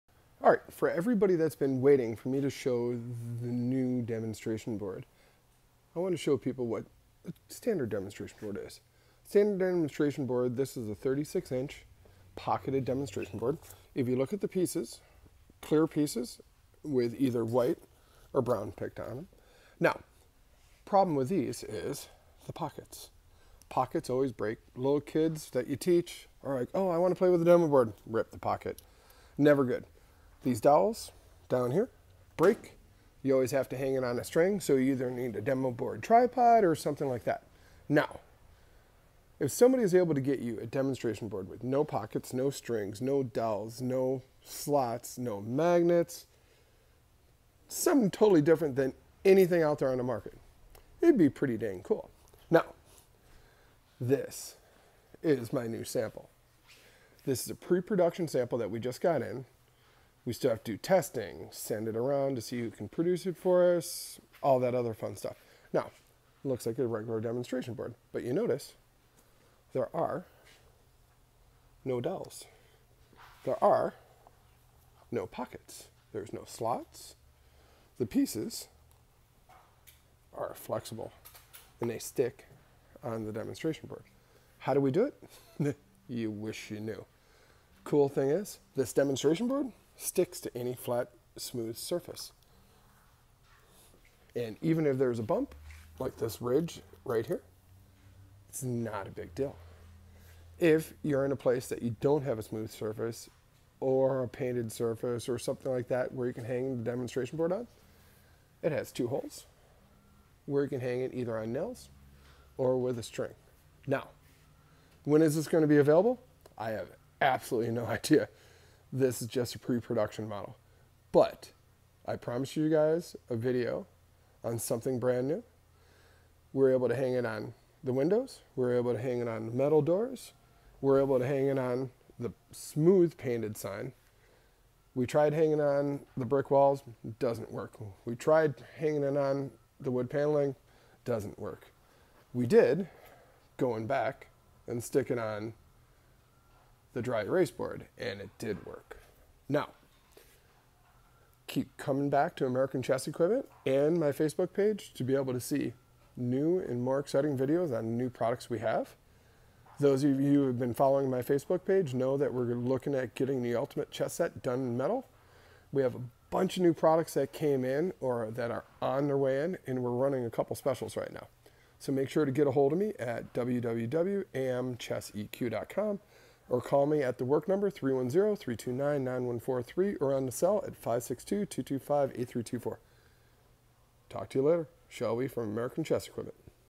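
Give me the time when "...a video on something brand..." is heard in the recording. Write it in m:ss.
2:03.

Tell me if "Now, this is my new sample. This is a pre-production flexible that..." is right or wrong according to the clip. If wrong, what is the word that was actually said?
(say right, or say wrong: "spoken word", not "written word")
wrong: "sample", not "flexible".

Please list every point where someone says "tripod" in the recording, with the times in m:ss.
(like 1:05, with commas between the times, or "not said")
0:36.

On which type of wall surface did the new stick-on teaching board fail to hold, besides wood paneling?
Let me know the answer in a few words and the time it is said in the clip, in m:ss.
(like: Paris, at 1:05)
Brick walls, at 2:16.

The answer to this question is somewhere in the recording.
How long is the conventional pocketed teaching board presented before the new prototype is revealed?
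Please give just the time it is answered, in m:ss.
0:10.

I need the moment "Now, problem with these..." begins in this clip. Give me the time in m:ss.
0:19.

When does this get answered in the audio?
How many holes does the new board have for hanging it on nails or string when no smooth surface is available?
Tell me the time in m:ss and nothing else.
1:48.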